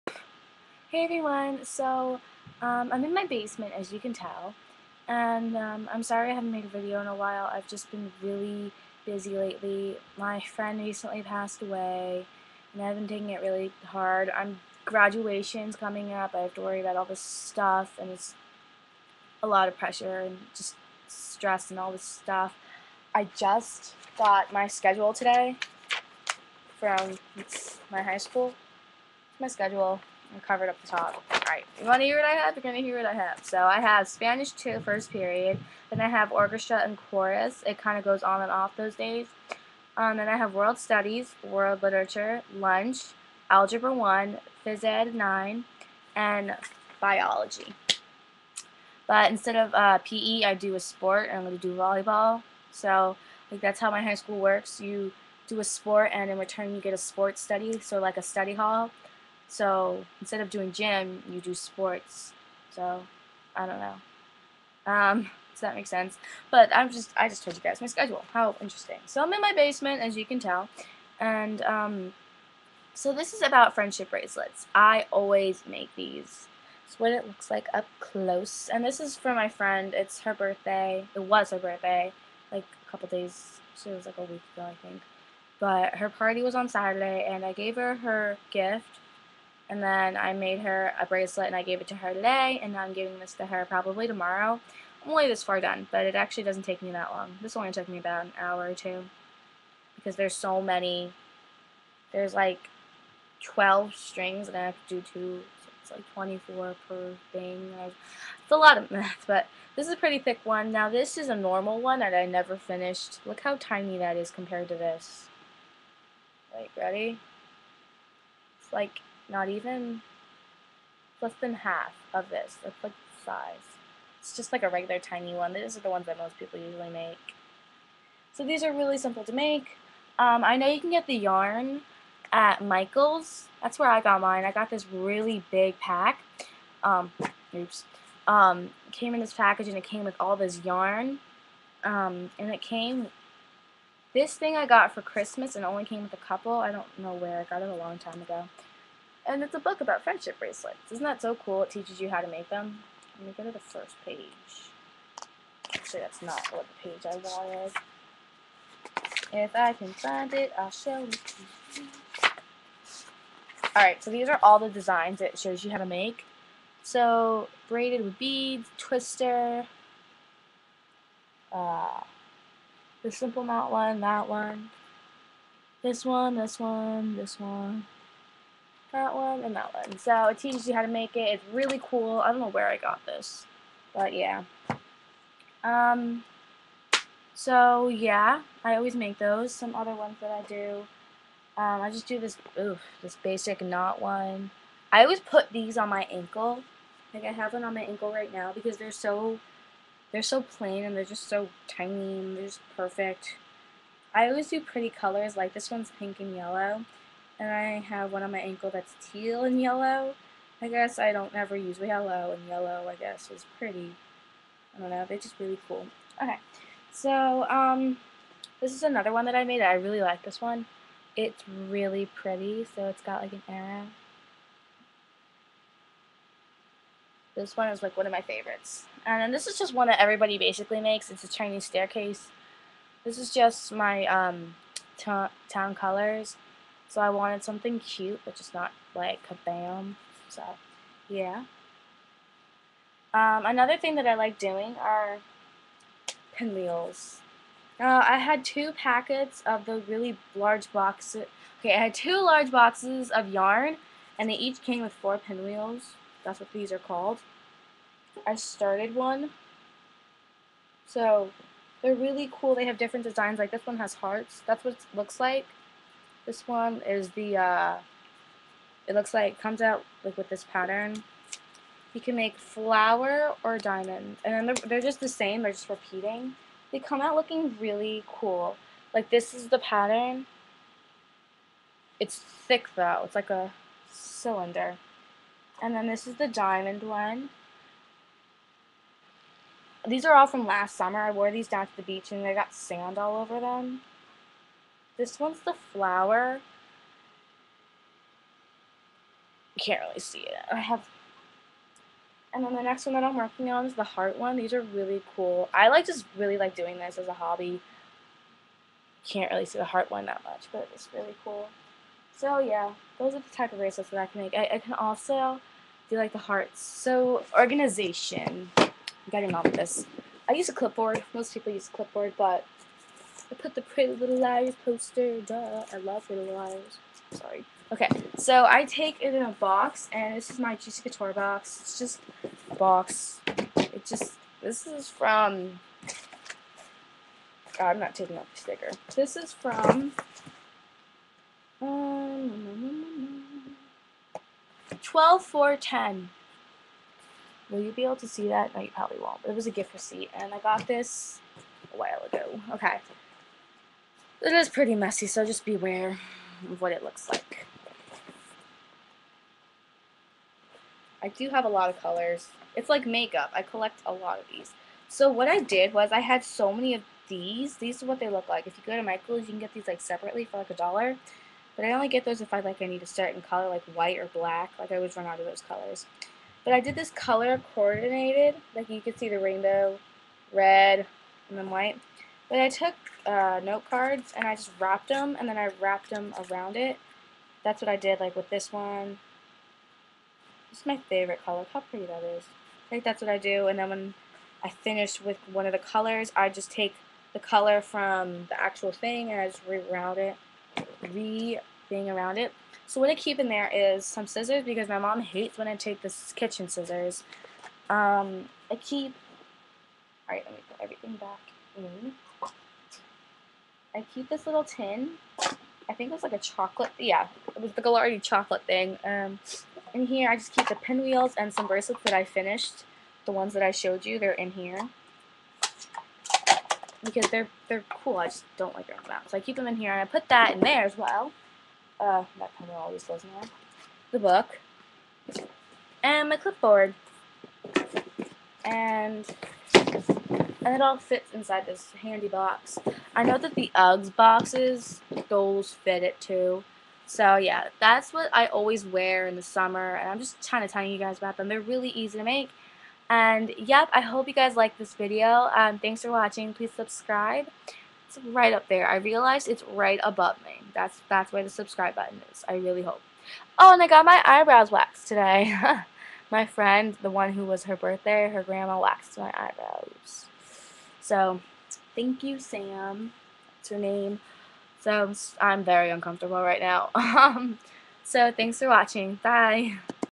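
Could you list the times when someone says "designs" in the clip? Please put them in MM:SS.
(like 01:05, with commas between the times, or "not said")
02:44, 04:23.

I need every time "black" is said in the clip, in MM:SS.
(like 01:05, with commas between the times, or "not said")
06:14.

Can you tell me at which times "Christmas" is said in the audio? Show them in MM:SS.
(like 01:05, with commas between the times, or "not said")
02:25.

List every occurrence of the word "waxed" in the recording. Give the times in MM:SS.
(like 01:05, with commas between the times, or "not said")
07:44, 07:48.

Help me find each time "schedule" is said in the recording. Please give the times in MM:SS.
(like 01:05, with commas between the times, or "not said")
00:24, 00:29, 01:07.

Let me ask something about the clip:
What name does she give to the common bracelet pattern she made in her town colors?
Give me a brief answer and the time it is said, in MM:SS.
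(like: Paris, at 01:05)
Chinese staircase, at 03:51.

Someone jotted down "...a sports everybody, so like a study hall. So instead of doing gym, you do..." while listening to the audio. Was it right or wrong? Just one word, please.
wrong.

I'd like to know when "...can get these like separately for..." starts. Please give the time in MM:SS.
06:09.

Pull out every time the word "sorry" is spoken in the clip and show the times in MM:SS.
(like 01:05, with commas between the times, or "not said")
00:06, 05:27.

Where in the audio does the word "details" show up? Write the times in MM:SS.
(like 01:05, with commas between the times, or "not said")
not said.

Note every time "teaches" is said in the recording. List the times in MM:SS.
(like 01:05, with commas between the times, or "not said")
02:31, 03:00.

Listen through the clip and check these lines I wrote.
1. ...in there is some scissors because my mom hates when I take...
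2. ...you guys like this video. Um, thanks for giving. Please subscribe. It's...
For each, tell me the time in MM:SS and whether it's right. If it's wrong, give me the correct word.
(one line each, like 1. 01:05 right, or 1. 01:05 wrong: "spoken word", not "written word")
1. 06:43 right
2. 07:34 wrong: "watching", not "giving".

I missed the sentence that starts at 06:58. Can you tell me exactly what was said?
Um, in here, I just keep the pinwheels and some bracelets that I finished.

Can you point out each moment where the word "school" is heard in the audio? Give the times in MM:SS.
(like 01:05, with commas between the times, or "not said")
00:28, 00:54.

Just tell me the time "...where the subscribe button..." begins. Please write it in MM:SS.
07:41.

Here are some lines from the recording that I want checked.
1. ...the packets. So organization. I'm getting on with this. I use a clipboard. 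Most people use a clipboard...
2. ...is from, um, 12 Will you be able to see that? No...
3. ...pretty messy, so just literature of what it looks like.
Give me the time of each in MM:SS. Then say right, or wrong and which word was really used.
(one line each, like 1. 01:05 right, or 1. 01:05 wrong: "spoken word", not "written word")
1. 05:16 wrong: "hearts", not "packets"
2. 05:39 right
3. 05:54 wrong: "beware", not "literature".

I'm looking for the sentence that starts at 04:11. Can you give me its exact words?
Okay, I had two large boxes of yarn, and they each came with four pinwheels.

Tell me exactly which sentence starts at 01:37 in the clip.
This only took me about an hour or two because there's so many.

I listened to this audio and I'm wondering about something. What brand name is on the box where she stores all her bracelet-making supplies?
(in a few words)
Juicy Couture.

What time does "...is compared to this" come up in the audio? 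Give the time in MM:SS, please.
01:54.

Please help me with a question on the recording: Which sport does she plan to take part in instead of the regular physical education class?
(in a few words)
Volleyball.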